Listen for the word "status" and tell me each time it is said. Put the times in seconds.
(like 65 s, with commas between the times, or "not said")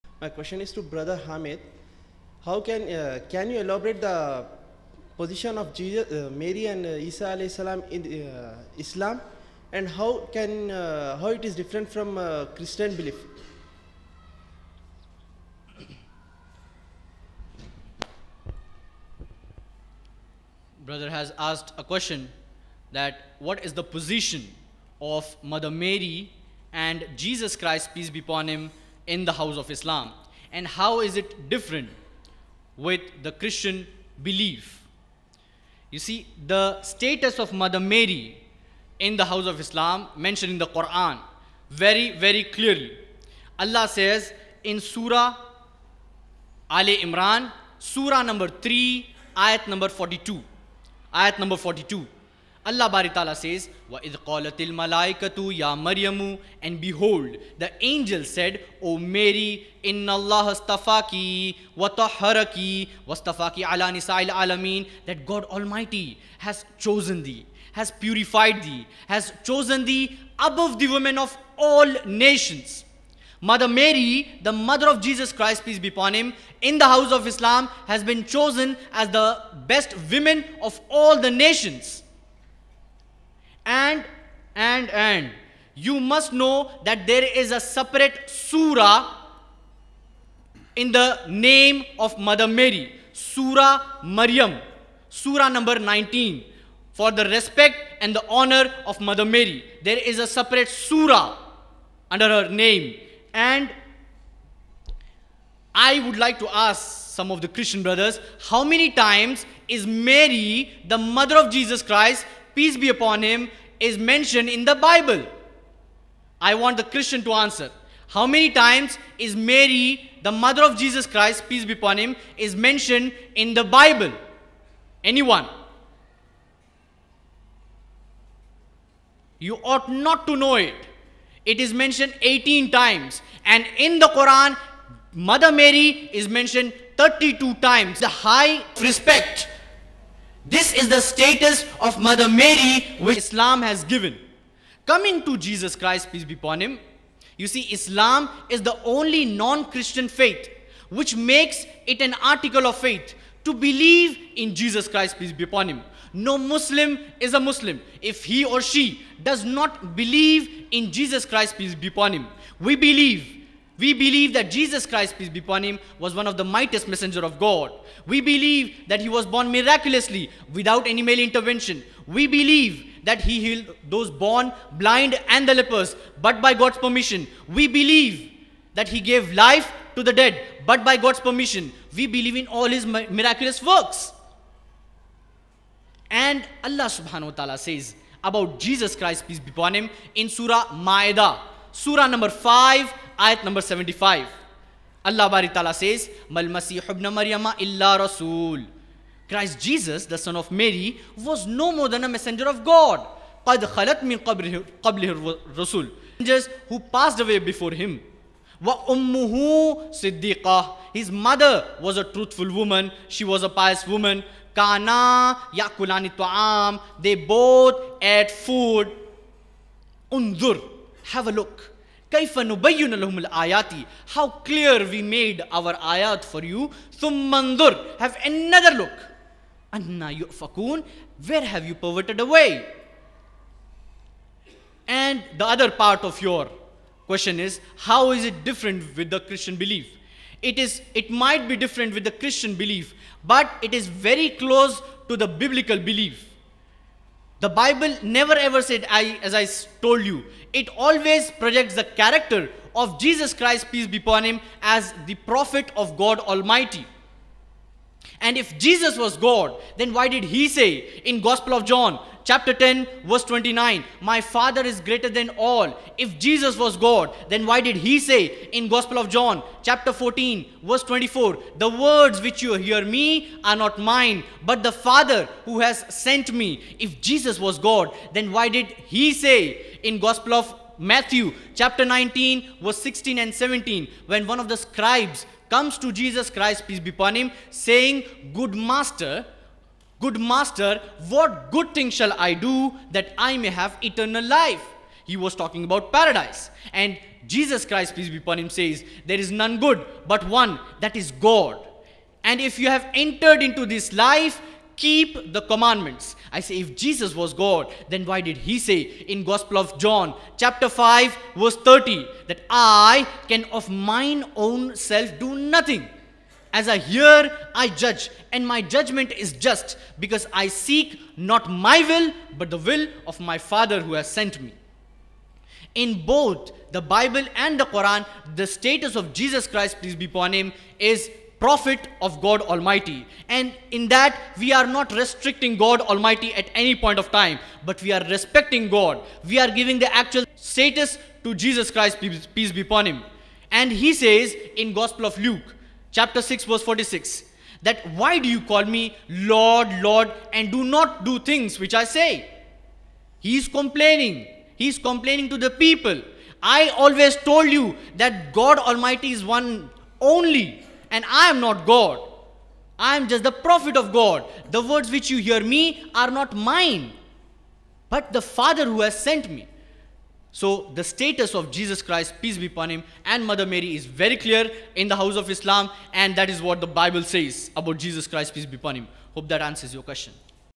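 36 s, 141 s, 328 s, 340 s, 370 s.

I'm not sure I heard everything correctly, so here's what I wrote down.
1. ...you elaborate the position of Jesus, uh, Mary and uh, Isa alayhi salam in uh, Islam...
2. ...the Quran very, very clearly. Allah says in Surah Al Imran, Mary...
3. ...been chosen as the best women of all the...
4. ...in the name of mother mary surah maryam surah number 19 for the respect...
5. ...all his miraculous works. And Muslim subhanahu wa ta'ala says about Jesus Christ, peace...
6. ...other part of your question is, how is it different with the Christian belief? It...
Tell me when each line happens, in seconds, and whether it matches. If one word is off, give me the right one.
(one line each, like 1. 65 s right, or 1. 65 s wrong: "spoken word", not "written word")
1. 3 s right
2. 40 s wrong: "Surah", not "Mary"
3. 78 s right
4. 90 s right
5. 182 s wrong: "Allah", not "Muslim"
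6. 235 s right.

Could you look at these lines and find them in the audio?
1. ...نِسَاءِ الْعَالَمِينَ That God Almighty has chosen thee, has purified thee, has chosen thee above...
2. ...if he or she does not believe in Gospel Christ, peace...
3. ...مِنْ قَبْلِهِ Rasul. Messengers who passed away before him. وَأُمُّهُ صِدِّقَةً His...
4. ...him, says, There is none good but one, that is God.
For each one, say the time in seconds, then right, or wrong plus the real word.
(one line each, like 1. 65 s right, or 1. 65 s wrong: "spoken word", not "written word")
1. 63 s right
2. 158 s wrong: "Jesus", not "Gospel"
3. 204 s right
4. 298 s right.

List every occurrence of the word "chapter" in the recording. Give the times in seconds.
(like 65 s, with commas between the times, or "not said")
262 s, 269 s, 281 s, 310 s, 345 s.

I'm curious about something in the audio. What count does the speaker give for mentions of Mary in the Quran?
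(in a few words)
32.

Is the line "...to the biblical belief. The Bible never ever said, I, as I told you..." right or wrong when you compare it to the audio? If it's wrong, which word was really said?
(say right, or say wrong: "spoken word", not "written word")
right.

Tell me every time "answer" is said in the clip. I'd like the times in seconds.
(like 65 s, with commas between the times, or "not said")
117 s, 379 s.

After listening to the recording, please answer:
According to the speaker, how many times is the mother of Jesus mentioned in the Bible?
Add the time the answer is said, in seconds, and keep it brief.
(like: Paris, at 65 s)
18, at 131 s.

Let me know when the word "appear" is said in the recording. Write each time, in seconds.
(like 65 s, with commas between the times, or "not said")
not said.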